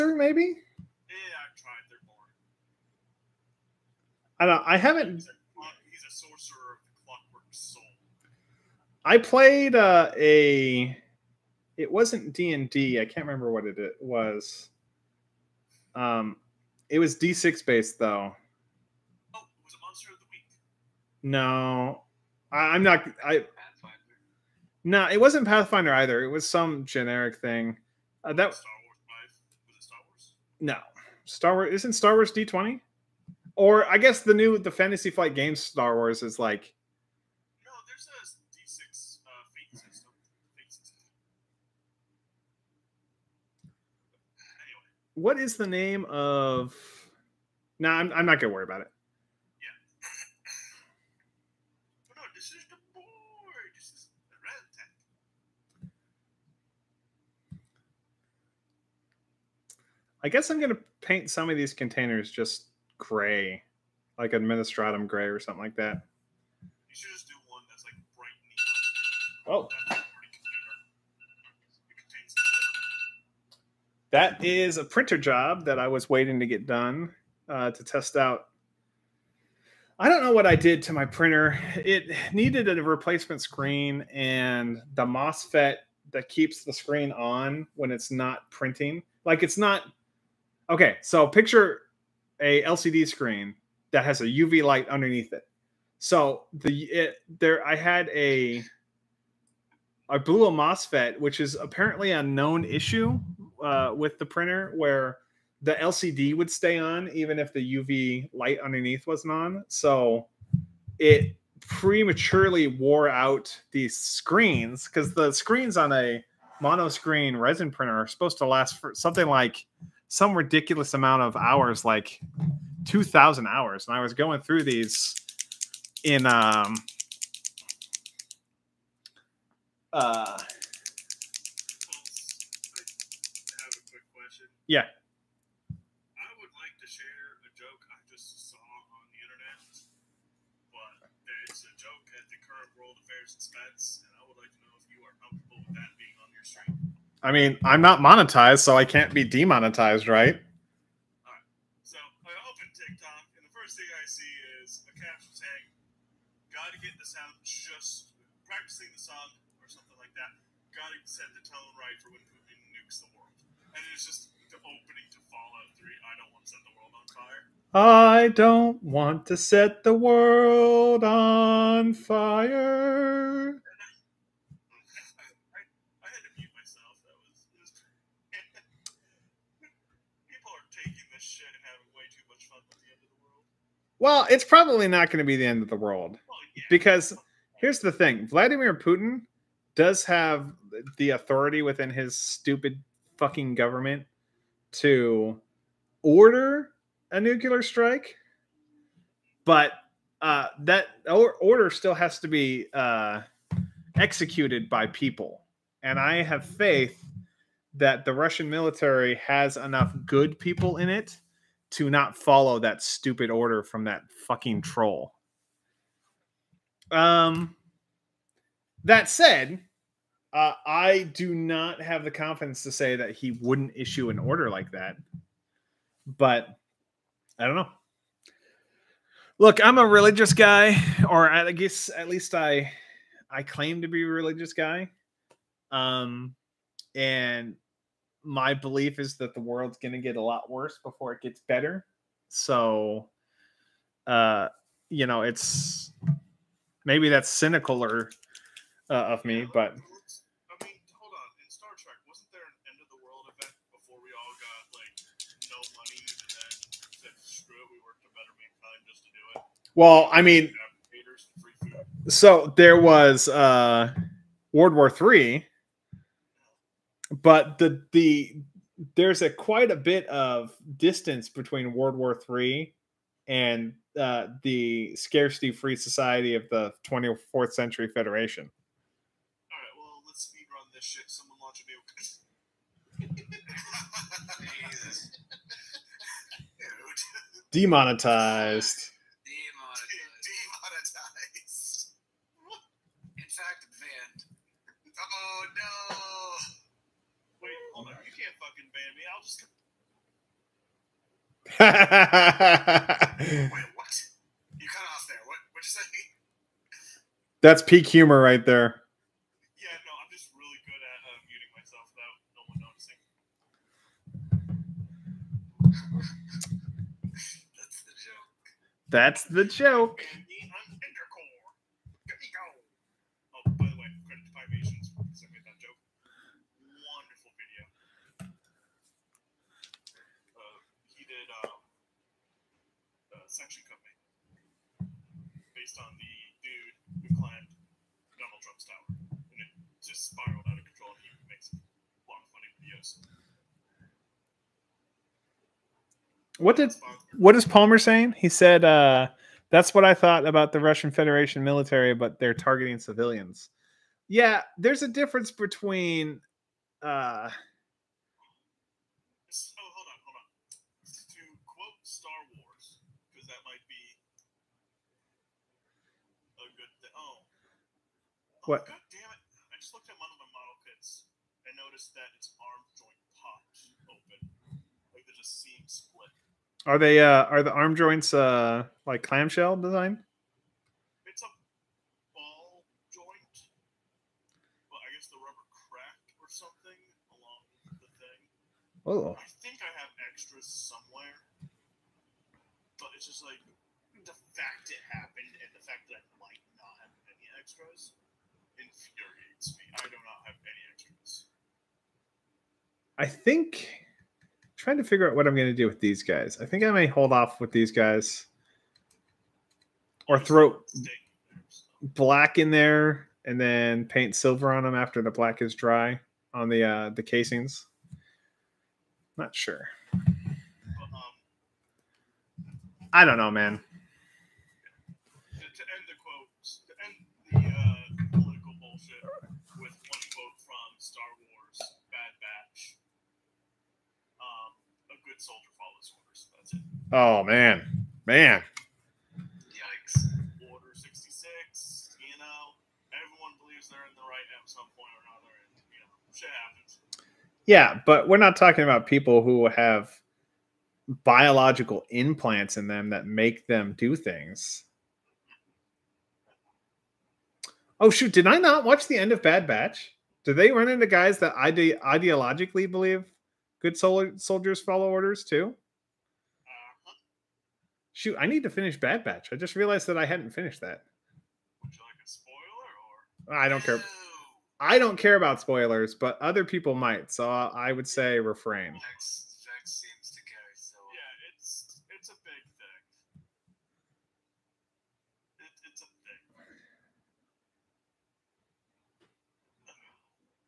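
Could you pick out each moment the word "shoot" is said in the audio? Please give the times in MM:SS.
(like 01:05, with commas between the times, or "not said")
07:37, 07:47.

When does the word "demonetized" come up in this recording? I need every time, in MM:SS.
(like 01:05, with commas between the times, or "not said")
02:29, 04:47.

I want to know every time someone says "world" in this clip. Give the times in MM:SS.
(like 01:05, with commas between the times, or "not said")
02:22, 02:49, 03:05, 03:59, 04:24, 04:31.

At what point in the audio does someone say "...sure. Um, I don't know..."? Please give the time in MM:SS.
06:59.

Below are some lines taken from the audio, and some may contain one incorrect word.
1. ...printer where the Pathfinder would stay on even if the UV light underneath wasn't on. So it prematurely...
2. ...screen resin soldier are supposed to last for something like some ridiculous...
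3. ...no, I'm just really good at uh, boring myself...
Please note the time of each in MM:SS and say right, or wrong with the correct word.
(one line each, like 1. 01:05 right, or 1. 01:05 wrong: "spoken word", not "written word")
1. 01:44 wrong: "LCD", not "Pathfinder"
2. 01:56 wrong: "printer", not "soldier"
3. 05:09 wrong: "muting", not "boring".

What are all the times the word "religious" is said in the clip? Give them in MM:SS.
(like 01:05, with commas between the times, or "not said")
03:49, 03:54.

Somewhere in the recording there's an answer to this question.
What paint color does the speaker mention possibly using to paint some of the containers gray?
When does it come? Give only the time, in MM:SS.
01:04.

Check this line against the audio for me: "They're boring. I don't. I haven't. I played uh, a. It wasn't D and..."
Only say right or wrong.
right.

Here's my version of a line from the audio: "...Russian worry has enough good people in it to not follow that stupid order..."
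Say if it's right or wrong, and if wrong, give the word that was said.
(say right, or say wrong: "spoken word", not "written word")
wrong: "military", not "worry".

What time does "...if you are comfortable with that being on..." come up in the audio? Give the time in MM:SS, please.
02:24.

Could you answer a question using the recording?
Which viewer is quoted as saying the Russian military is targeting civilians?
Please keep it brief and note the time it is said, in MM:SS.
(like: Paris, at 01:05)
Palmer, at 05:47.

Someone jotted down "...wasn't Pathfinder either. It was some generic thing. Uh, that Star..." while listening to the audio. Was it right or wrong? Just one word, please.
right.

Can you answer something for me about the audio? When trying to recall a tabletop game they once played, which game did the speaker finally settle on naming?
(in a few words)
Monster of the Week.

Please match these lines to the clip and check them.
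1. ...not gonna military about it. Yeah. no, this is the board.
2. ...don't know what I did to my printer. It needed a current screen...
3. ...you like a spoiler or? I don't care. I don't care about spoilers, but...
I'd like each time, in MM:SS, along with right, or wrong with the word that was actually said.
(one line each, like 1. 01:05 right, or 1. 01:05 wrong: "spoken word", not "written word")
1. 00:48 wrong: "worry", not "military"
2. 01:20 wrong: "replacement", not "current"
3. 07:51 right.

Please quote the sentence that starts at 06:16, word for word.
Are they uh are the arm joints uh like clamshell design?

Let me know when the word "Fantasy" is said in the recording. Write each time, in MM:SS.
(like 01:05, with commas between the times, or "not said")
00:34.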